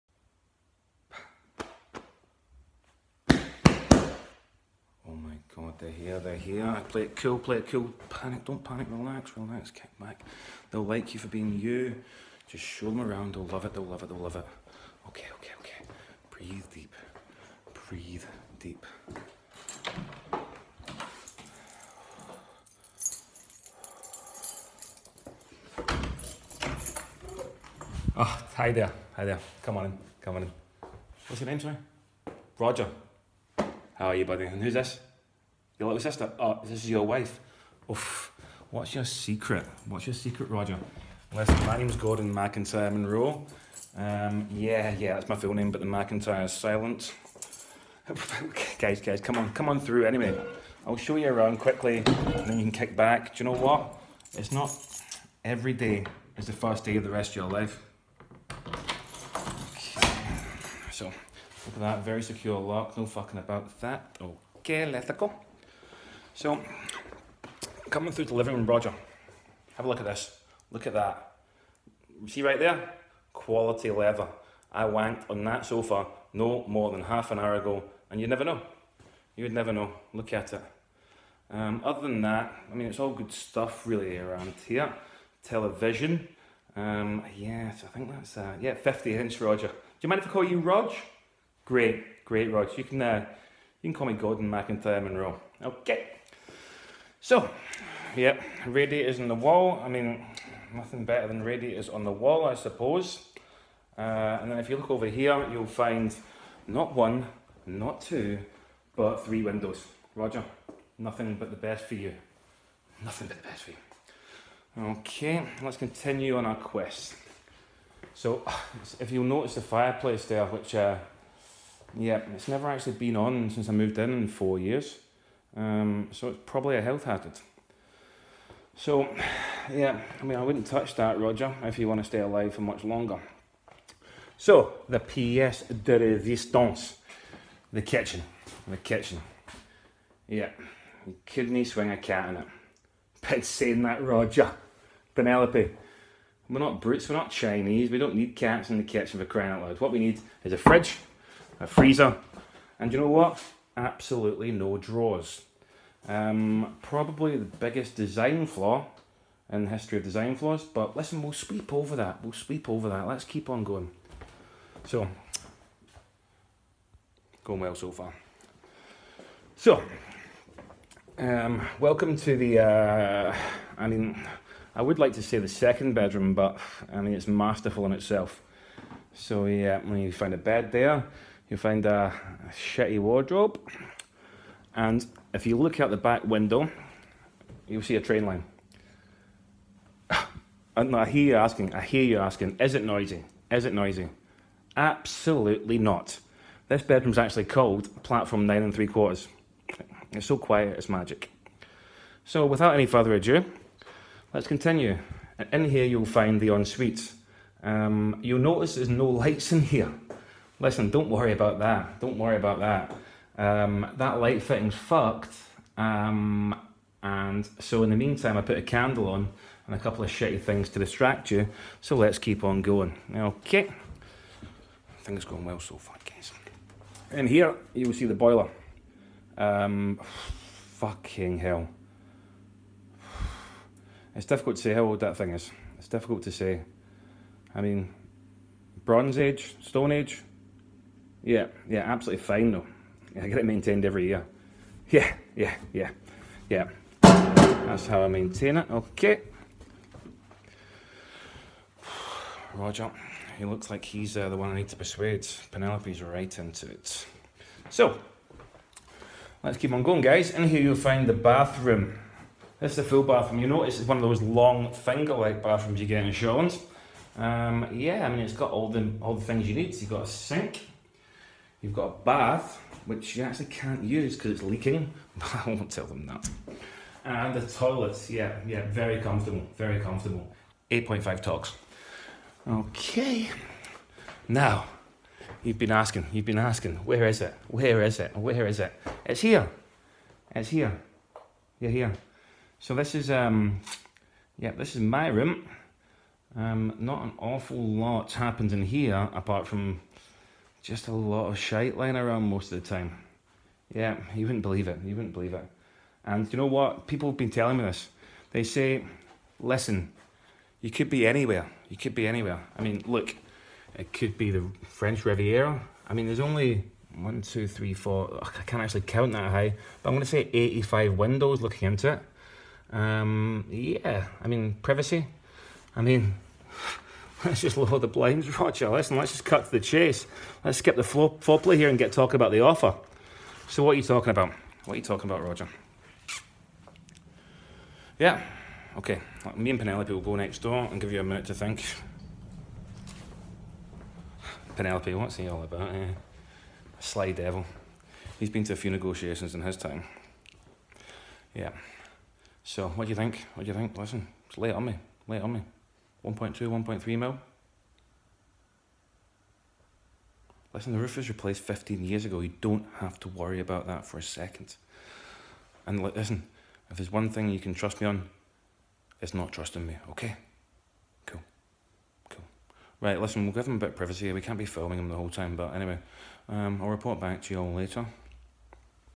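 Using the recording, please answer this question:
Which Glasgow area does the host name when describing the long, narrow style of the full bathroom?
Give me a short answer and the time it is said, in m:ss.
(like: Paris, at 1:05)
Shawlands, at 4:26.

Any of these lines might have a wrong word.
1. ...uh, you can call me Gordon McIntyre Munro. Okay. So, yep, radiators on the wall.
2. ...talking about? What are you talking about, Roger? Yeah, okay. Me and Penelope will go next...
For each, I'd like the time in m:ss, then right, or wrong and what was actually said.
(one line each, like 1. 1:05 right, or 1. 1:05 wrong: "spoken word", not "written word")
1. 1:33 right
2. 5:33 right.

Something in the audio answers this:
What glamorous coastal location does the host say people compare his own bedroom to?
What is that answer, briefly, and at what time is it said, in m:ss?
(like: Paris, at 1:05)
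French Riviera, at 5:14.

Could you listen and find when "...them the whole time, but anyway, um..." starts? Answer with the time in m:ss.
6:14.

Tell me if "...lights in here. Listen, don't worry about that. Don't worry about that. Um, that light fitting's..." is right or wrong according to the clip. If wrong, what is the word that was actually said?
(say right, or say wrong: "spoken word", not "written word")
right.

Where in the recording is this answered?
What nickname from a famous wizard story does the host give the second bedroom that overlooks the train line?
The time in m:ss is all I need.
3:18.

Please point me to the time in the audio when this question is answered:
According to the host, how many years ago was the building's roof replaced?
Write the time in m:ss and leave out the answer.
6:01.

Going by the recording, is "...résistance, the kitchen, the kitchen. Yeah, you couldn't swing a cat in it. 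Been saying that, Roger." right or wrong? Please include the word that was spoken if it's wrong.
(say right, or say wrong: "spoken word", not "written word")
right.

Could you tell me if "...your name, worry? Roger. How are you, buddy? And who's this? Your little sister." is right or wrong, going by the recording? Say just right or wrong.
wrong.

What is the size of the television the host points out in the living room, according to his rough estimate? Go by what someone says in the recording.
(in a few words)
50 inch.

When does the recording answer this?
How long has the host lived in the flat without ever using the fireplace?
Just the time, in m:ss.
2:04.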